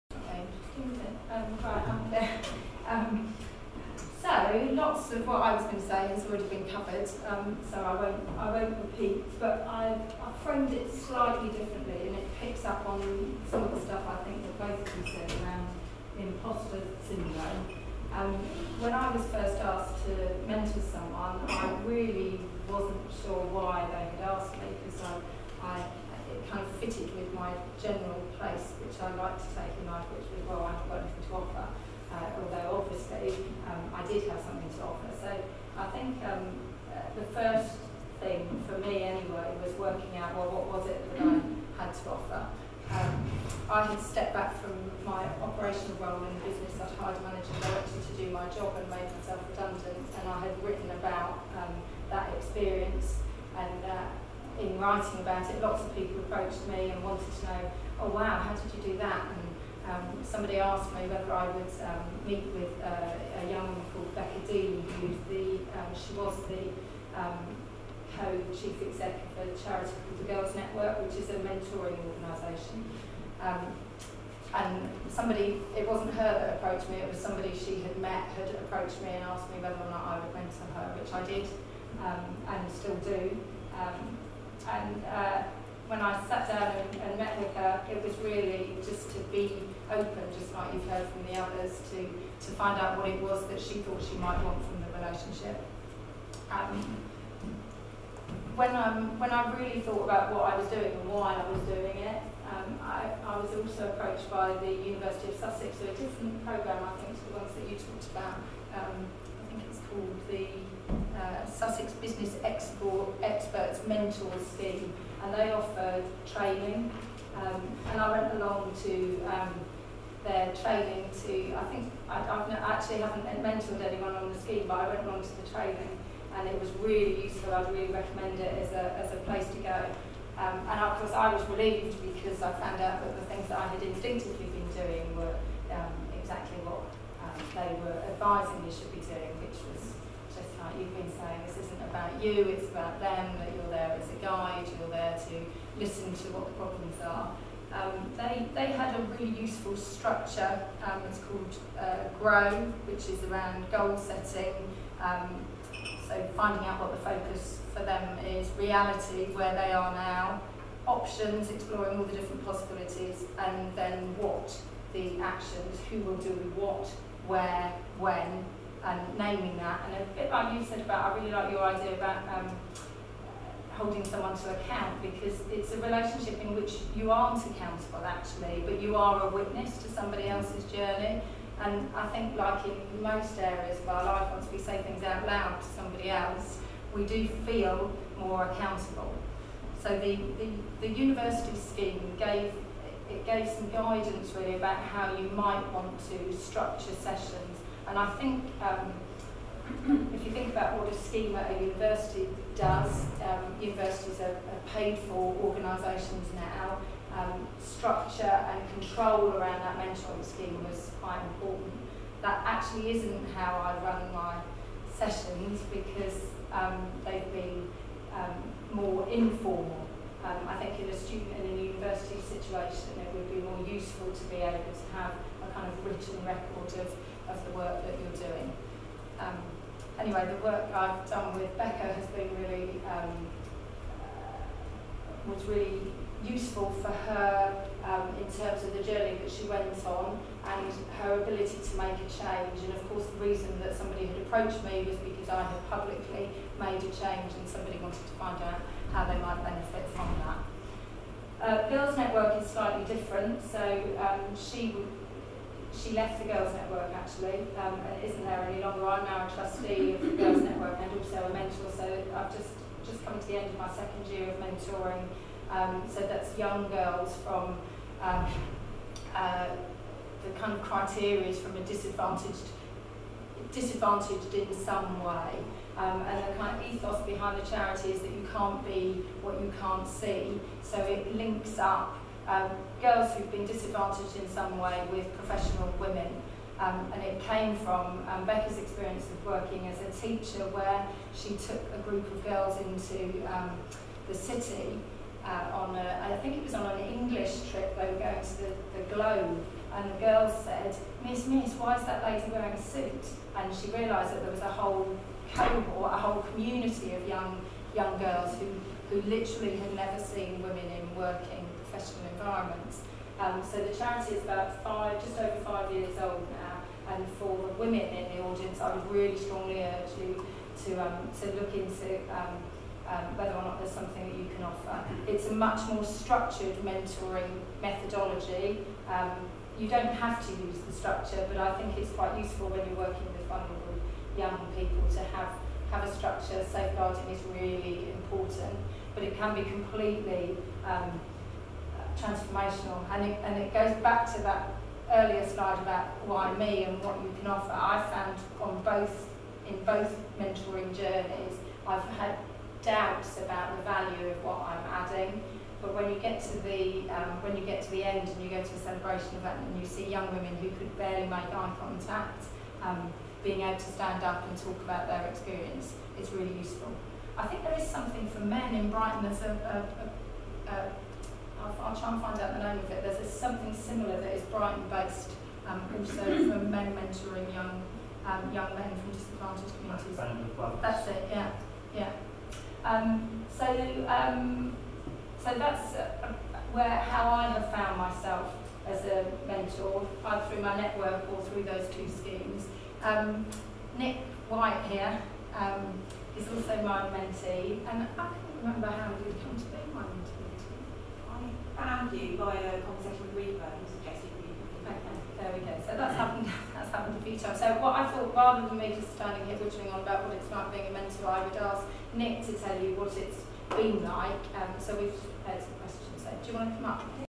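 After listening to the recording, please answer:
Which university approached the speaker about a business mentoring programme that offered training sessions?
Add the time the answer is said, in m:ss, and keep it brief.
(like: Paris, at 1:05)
University of Sussex, at 1:44.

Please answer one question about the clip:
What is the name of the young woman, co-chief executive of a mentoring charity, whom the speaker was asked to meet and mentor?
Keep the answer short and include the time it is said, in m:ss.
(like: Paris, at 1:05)
Becca Dean, at 1:04.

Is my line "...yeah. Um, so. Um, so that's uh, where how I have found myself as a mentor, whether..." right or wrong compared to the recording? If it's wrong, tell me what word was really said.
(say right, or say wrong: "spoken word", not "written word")
wrong: "either", not "whether".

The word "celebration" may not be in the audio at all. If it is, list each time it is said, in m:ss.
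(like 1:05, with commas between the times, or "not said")
5:58.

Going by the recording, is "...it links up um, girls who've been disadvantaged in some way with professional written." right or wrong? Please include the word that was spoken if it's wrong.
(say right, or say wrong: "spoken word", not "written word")
wrong: "women", not "written".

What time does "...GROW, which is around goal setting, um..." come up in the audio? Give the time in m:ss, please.
2:32.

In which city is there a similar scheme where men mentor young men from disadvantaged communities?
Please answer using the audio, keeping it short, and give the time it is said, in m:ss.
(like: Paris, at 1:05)
Brighton, at 6:14.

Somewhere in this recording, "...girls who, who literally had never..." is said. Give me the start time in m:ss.
5:07.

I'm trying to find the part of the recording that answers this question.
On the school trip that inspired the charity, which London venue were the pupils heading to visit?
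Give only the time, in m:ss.
4:58.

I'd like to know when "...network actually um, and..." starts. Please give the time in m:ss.
4:16.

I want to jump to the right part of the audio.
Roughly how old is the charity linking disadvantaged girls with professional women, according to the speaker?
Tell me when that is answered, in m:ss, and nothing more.
5:15.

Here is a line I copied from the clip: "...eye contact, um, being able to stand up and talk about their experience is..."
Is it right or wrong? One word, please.
right.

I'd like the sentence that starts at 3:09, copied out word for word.
So the, the, the university scheme gave it gave some guidance really about how you might want to structure sessions.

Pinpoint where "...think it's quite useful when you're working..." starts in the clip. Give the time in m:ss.
5:31.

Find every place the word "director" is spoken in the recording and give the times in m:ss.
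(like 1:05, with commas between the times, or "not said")
0:47.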